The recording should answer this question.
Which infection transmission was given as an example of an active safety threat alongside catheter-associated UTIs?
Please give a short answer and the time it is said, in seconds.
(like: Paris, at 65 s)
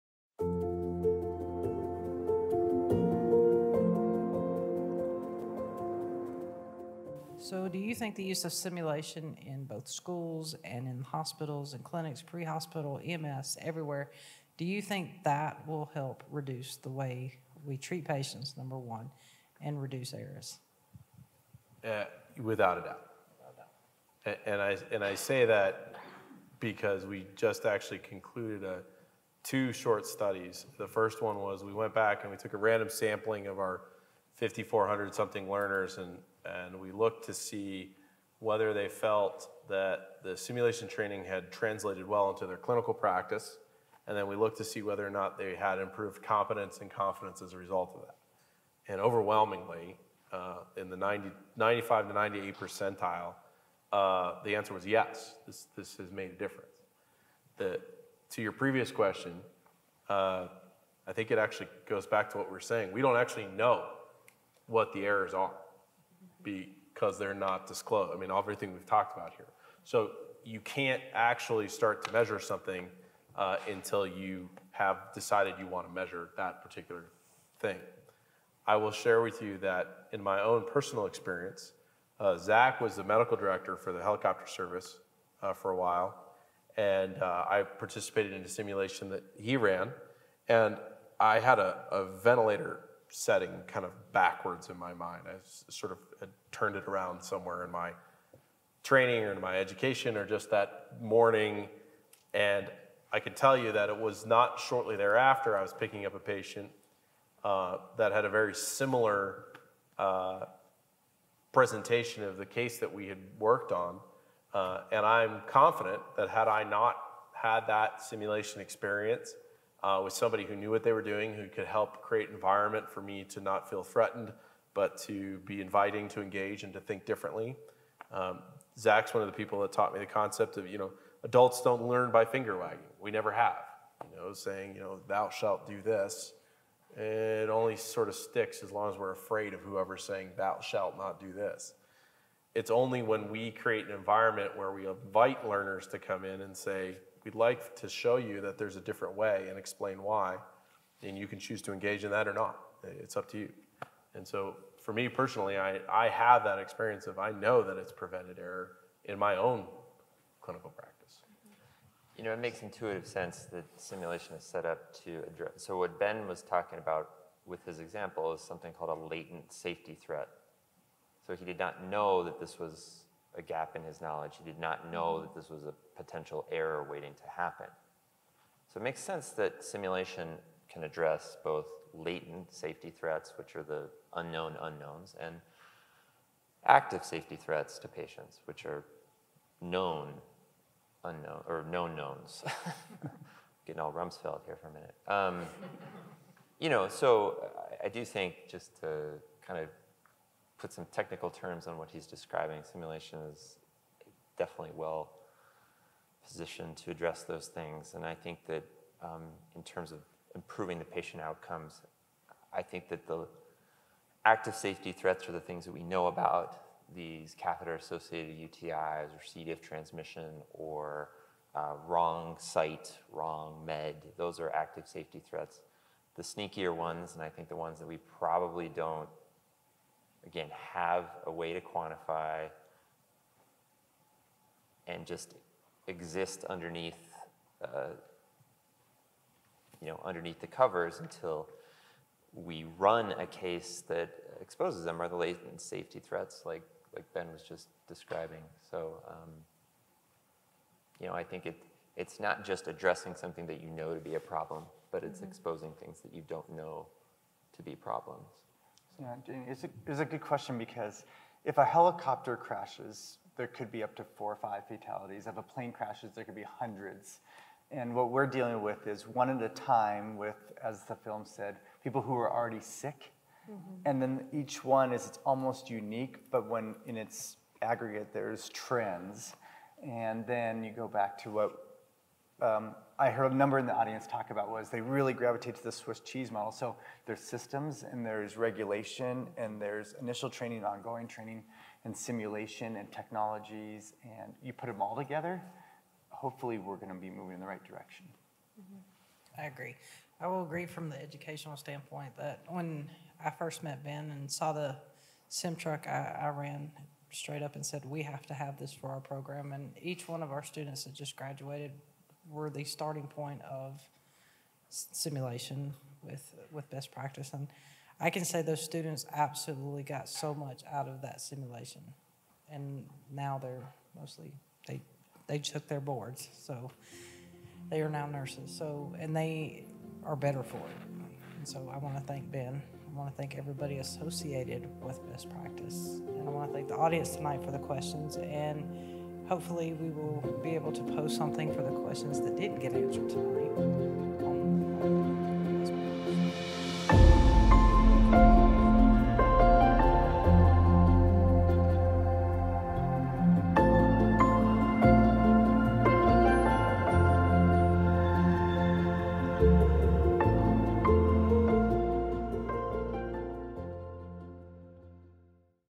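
C. diff, at 219 s.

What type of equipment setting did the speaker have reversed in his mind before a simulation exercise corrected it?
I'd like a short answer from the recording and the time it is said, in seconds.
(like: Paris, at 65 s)
Ventilator setting, at 92 s.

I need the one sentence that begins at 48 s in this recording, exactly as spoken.
And overwhelmingly, uh, in the 90, 95 to 98 percentile, uh, the answer was yes, this, this has made a difference.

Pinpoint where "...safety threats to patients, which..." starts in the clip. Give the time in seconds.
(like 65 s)
187 s.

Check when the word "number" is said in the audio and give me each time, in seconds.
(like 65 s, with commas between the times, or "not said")
18 s, 283 s.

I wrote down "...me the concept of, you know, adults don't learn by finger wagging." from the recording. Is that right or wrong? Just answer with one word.
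right.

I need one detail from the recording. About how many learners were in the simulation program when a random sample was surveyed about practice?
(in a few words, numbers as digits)
5,400.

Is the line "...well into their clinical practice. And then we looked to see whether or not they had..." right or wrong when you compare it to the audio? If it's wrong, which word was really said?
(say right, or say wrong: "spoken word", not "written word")
right.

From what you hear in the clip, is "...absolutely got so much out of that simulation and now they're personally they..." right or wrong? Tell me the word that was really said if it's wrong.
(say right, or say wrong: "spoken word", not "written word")
wrong: "mostly", not "personally".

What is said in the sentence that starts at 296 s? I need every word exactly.
Hopefully, we're going to be moving in the right direction.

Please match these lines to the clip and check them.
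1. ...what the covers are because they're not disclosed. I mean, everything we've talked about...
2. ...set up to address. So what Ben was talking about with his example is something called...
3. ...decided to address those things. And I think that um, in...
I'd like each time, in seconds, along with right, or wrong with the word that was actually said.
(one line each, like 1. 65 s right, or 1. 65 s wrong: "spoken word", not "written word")
1. 64 s wrong: "errors", not "covers"
2. 164 s right
3. 206 s wrong: "positioned", not "decided".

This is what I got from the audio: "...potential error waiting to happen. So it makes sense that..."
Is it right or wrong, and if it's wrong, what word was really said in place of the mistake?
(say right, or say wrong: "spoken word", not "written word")
right.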